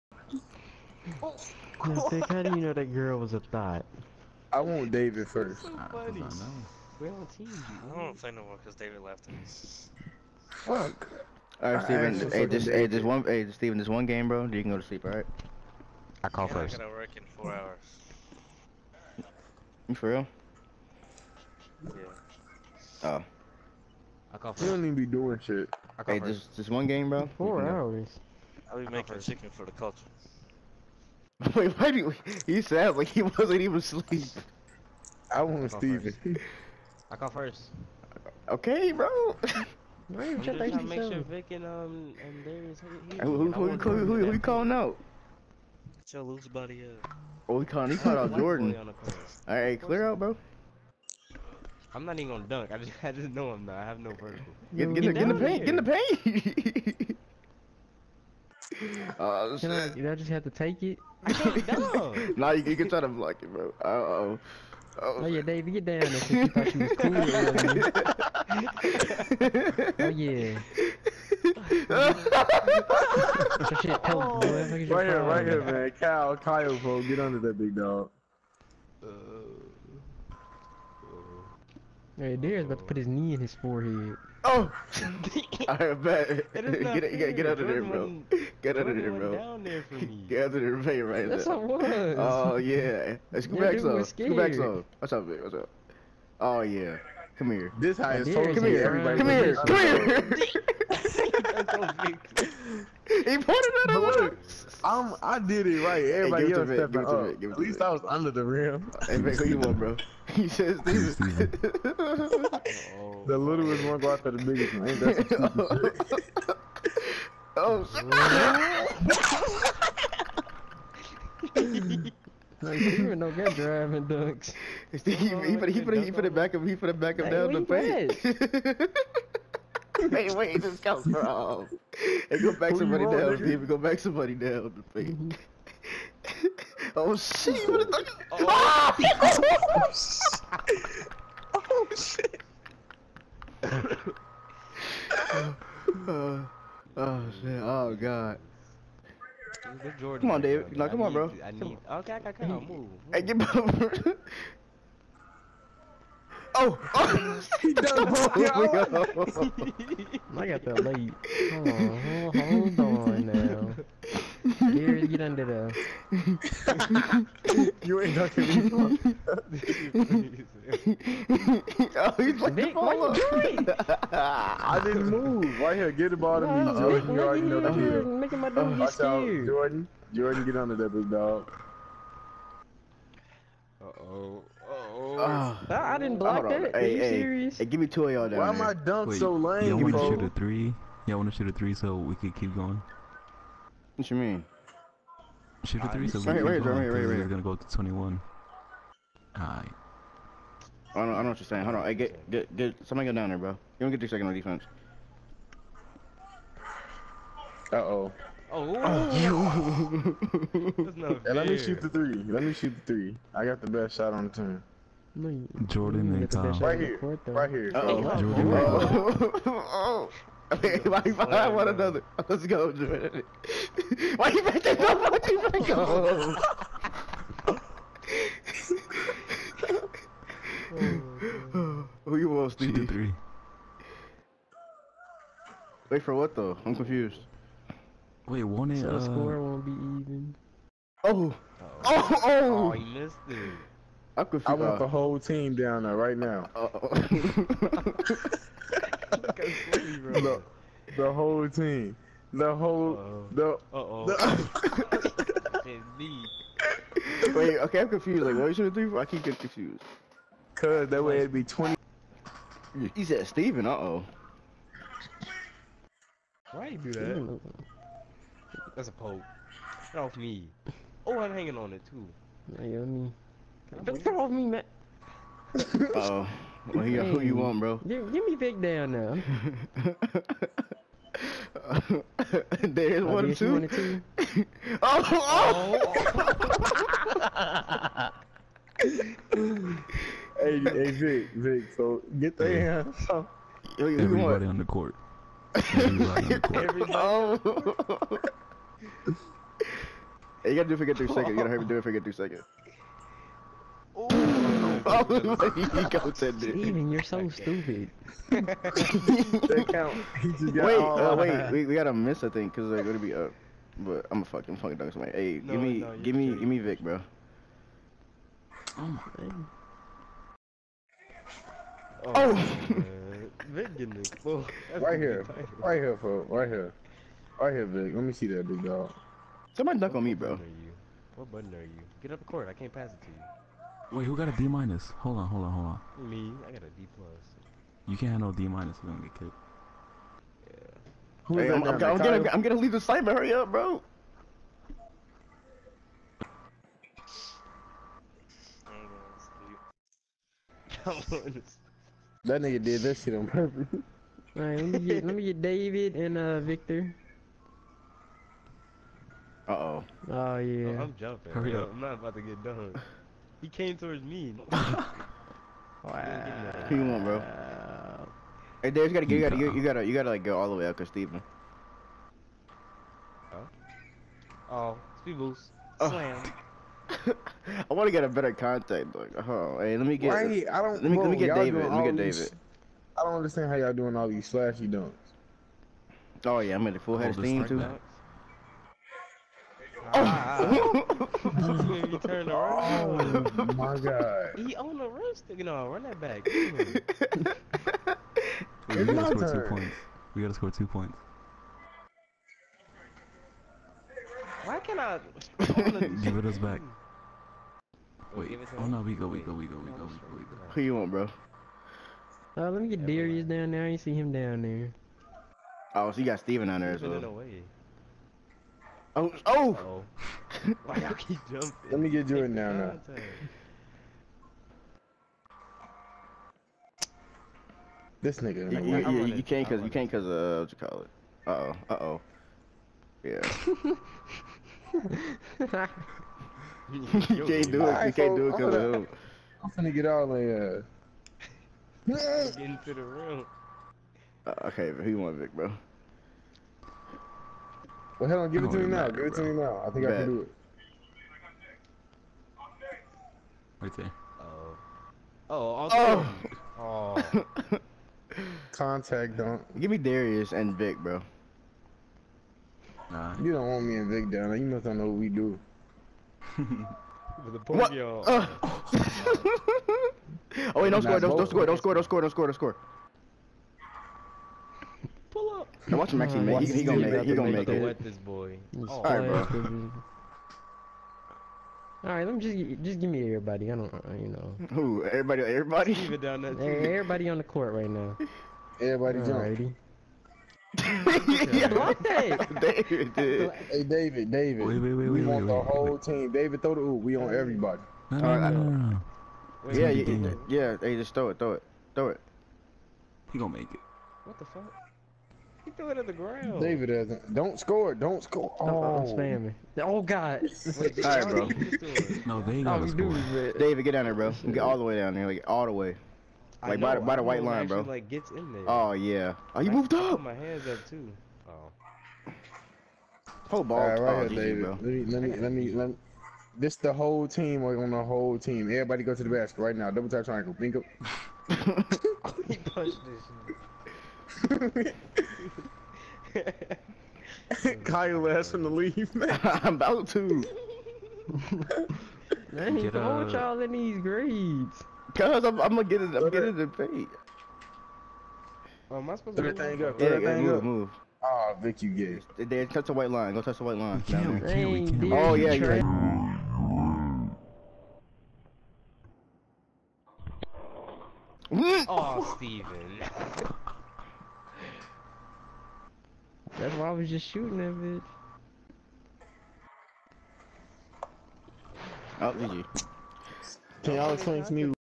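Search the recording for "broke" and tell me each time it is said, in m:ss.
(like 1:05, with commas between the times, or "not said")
2:38.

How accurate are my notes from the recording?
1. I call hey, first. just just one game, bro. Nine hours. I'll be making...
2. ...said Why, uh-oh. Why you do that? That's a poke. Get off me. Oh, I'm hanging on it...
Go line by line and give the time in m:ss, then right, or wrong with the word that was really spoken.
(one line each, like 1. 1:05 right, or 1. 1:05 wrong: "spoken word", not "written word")
1. 0:25 wrong: "Four", not "Nine"
2. 4:23 wrong: "Steven", not "Why".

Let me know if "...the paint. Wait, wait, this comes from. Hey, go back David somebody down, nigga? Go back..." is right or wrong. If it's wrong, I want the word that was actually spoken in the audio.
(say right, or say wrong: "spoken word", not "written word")
wrong: "Who", not "David".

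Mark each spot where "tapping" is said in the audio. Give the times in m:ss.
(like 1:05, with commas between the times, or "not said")
not said.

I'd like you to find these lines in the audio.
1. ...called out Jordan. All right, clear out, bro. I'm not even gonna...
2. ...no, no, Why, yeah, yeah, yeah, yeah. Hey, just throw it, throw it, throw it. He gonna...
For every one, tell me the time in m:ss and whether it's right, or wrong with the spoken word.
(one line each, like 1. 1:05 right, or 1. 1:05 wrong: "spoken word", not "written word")
1. 0:47 right
2. 8:18 wrong: "Wait", not "Why".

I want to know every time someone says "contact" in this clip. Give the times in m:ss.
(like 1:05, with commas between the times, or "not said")
6:18, 7:38.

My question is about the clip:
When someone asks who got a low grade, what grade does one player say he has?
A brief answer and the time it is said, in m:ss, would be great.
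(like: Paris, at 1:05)
D plus, at 5:36.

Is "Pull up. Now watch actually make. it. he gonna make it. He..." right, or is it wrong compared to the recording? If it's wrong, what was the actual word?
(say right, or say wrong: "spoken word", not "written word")
right.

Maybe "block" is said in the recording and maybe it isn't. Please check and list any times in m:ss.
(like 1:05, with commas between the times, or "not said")
1:03, 3:06.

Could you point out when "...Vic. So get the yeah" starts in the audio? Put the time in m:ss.
4:51.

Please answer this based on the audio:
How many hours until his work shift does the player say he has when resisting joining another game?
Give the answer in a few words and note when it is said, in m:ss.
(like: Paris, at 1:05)
4, at 0:16.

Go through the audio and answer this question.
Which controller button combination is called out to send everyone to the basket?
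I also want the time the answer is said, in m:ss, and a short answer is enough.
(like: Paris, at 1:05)
Double tap triangle, at 8:49.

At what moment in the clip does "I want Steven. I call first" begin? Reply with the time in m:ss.
0:35.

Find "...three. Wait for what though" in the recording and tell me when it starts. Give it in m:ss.
3:52.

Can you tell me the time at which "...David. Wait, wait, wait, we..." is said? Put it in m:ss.
8:14.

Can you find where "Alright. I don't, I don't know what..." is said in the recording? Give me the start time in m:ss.
3:19.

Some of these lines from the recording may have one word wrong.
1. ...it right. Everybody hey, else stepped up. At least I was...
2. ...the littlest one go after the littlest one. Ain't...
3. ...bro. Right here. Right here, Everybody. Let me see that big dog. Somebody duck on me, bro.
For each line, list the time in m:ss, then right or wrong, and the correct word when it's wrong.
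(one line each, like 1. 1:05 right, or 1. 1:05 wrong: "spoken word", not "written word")
1. 1:45 right
2. 1:53 wrong: "biggest", not "littlest"
3. 5:26 wrong: "Vic", not "Everybody".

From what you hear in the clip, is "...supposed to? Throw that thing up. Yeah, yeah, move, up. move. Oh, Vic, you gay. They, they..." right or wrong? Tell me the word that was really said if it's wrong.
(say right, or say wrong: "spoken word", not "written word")
right.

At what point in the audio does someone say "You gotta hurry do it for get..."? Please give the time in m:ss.
5:01.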